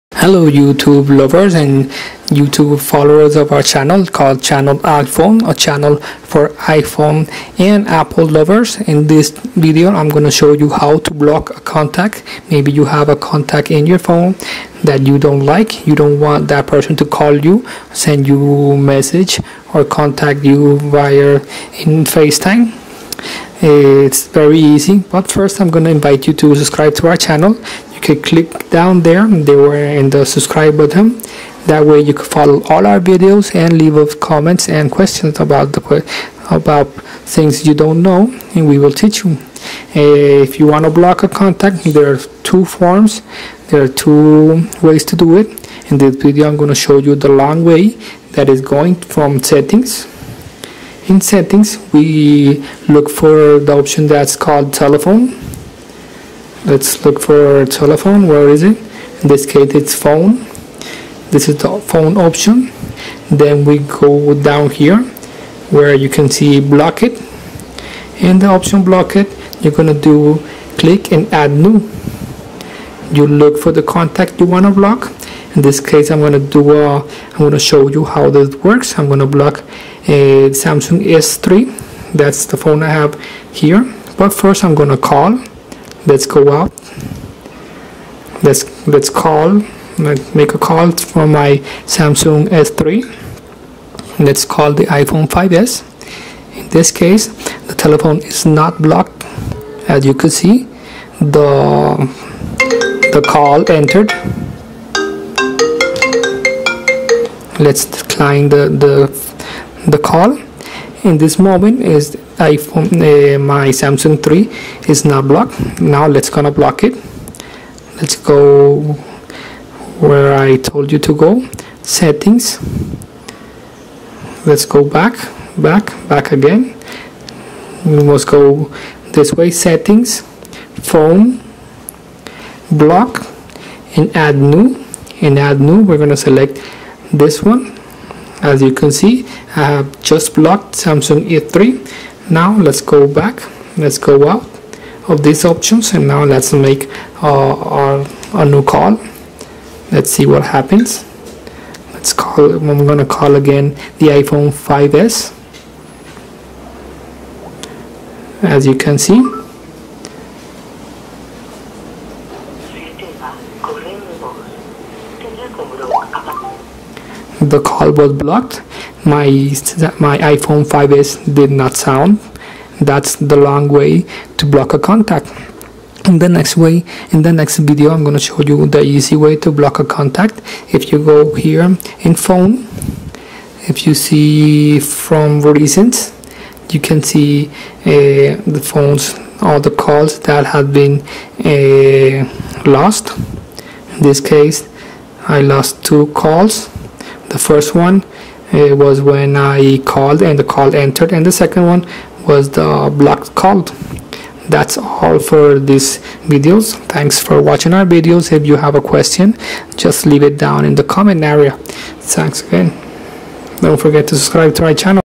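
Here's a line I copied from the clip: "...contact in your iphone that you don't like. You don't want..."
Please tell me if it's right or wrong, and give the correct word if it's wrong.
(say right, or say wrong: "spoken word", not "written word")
wrong: "phone", not "iphone".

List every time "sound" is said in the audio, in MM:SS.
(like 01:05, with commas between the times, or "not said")
02:51.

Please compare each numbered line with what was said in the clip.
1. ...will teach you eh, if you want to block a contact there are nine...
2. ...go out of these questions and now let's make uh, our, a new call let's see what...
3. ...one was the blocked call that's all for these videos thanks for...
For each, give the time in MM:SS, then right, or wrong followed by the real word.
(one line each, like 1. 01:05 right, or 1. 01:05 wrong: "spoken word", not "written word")
1. 00:38 wrong: "two", not "nine"
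2. 02:23 wrong: "options", not "questions"
3. 03:21 right.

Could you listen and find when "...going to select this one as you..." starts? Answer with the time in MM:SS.
02:16.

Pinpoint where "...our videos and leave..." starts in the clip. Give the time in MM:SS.
00:32.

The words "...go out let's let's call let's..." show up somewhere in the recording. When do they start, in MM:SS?
01:26.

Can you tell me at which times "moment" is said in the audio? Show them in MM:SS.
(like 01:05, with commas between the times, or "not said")
01:51.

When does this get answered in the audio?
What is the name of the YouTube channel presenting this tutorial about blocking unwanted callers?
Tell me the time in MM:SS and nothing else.
00:04.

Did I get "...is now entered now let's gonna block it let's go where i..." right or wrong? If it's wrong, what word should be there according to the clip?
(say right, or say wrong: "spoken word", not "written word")
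wrong: "blocked", not "entered".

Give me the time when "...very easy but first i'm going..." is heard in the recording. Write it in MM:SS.
00:24.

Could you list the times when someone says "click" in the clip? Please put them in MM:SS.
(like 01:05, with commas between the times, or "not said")
00:28, 01:10.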